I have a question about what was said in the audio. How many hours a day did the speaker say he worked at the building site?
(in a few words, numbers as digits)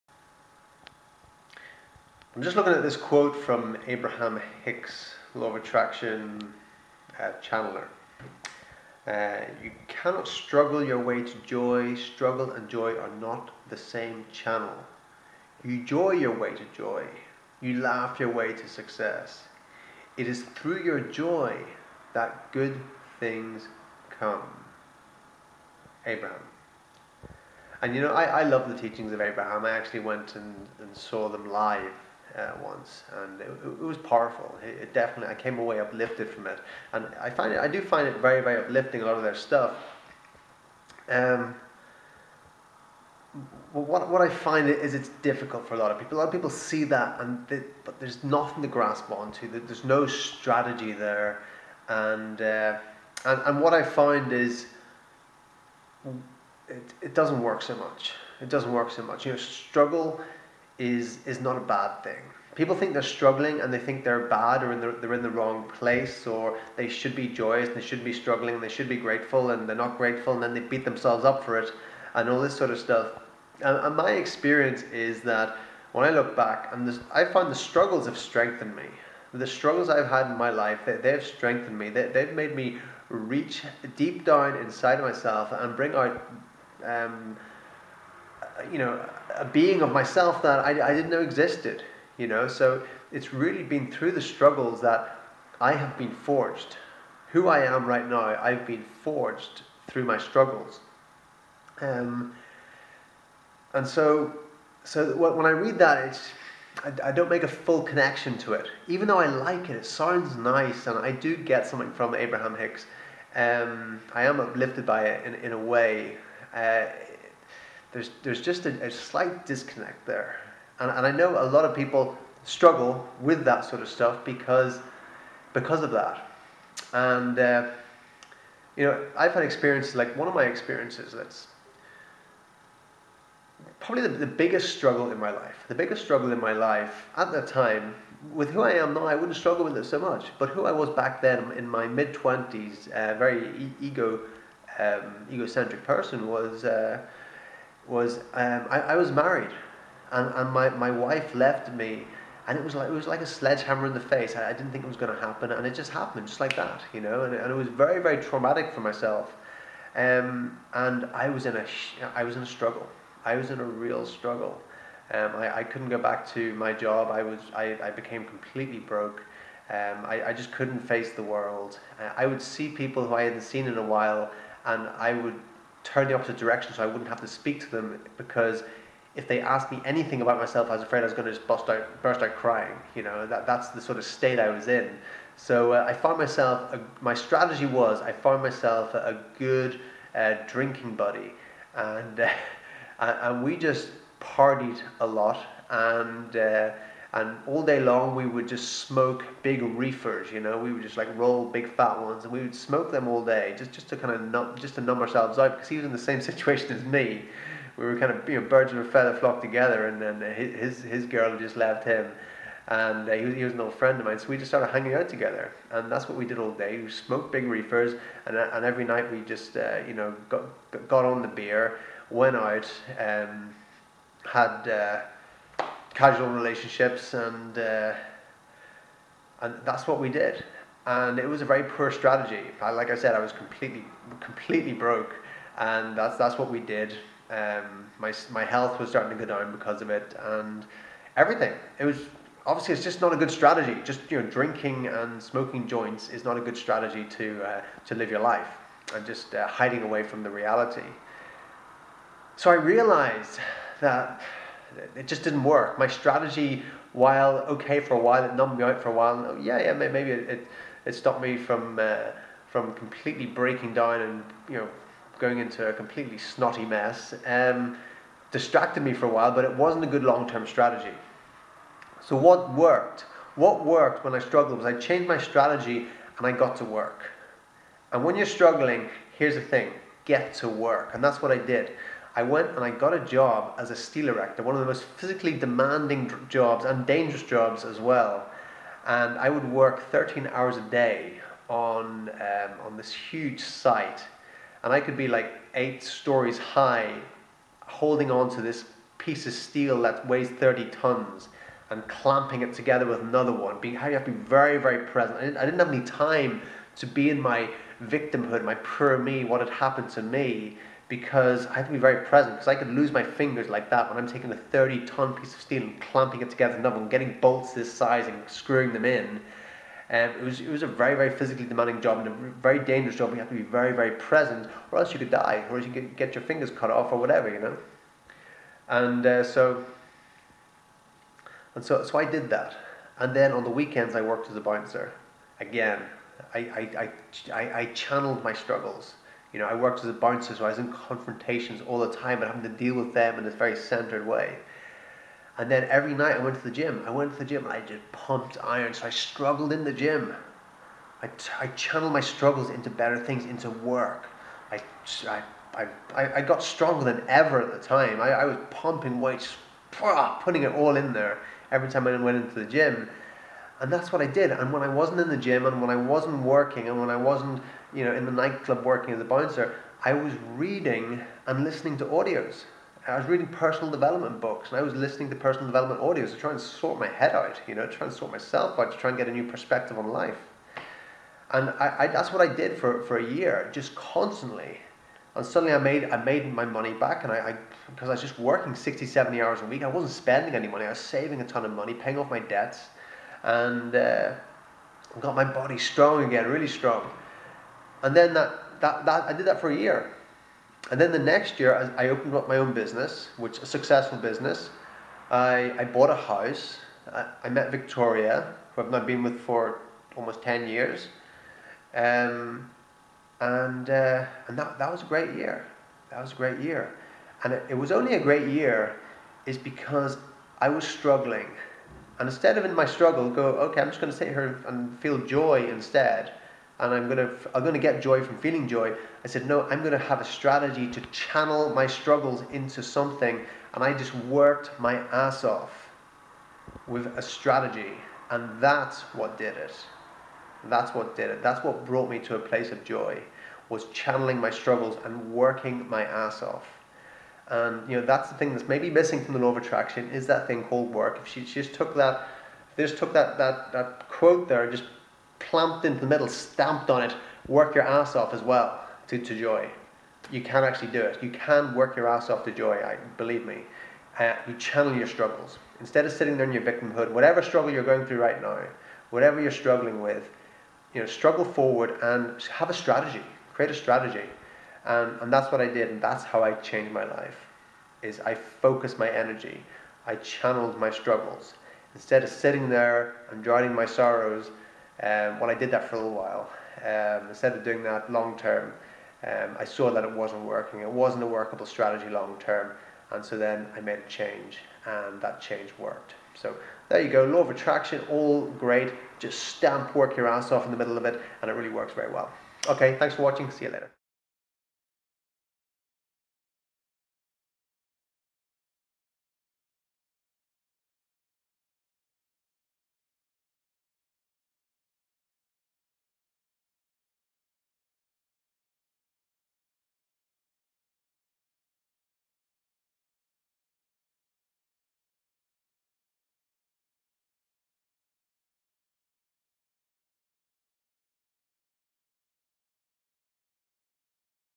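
13.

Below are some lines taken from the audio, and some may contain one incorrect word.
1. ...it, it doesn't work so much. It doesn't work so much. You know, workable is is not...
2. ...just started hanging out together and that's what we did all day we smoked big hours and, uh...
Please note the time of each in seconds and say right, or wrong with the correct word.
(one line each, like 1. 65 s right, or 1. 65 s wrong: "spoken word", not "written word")
1. 56 s wrong: "struggle", not "workable"
2. 214 s wrong: "reefers", not "hours".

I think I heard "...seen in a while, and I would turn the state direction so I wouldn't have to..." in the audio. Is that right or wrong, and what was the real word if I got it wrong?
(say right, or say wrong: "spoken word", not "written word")
wrong: "opposite", not "state".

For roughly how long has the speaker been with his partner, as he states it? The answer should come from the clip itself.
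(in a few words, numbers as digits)
Almost 10 years.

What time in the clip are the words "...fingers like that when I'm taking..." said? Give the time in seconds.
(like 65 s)
313 s.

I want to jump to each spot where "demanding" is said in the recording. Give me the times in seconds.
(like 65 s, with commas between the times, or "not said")
285 s, 321 s.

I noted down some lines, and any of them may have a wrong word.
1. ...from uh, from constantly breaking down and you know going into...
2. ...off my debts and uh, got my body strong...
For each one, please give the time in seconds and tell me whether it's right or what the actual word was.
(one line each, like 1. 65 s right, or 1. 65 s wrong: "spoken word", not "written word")
1. 261 s wrong: "completely", not "constantly"
2. 391 s right.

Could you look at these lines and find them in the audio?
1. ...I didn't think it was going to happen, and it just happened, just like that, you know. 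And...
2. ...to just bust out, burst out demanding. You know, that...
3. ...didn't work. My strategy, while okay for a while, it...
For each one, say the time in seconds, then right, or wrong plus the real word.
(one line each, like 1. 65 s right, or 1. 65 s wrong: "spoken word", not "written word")
1. 154 s right
2. 181 s wrong: "crying", not "demanding"
3. 255 s right.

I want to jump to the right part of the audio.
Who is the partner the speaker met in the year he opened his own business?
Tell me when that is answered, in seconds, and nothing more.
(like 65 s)
407 s.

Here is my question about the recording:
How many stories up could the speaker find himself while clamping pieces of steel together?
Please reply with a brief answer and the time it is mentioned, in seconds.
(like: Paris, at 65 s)
8, at 295 s.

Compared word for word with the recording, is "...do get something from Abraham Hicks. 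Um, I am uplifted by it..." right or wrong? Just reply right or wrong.
right.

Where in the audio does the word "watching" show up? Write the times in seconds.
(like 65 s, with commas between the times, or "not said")
503 s.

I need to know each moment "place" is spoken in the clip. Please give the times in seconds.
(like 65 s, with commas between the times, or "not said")
65 s, 442 s.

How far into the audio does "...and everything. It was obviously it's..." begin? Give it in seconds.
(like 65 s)
240 s.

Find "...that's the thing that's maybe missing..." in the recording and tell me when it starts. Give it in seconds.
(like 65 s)
447 s.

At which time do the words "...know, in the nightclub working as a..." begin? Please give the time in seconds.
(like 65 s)
367 s.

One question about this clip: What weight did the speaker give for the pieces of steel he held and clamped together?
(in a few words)
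30 tons.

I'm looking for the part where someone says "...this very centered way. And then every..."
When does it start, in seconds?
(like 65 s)
343 s.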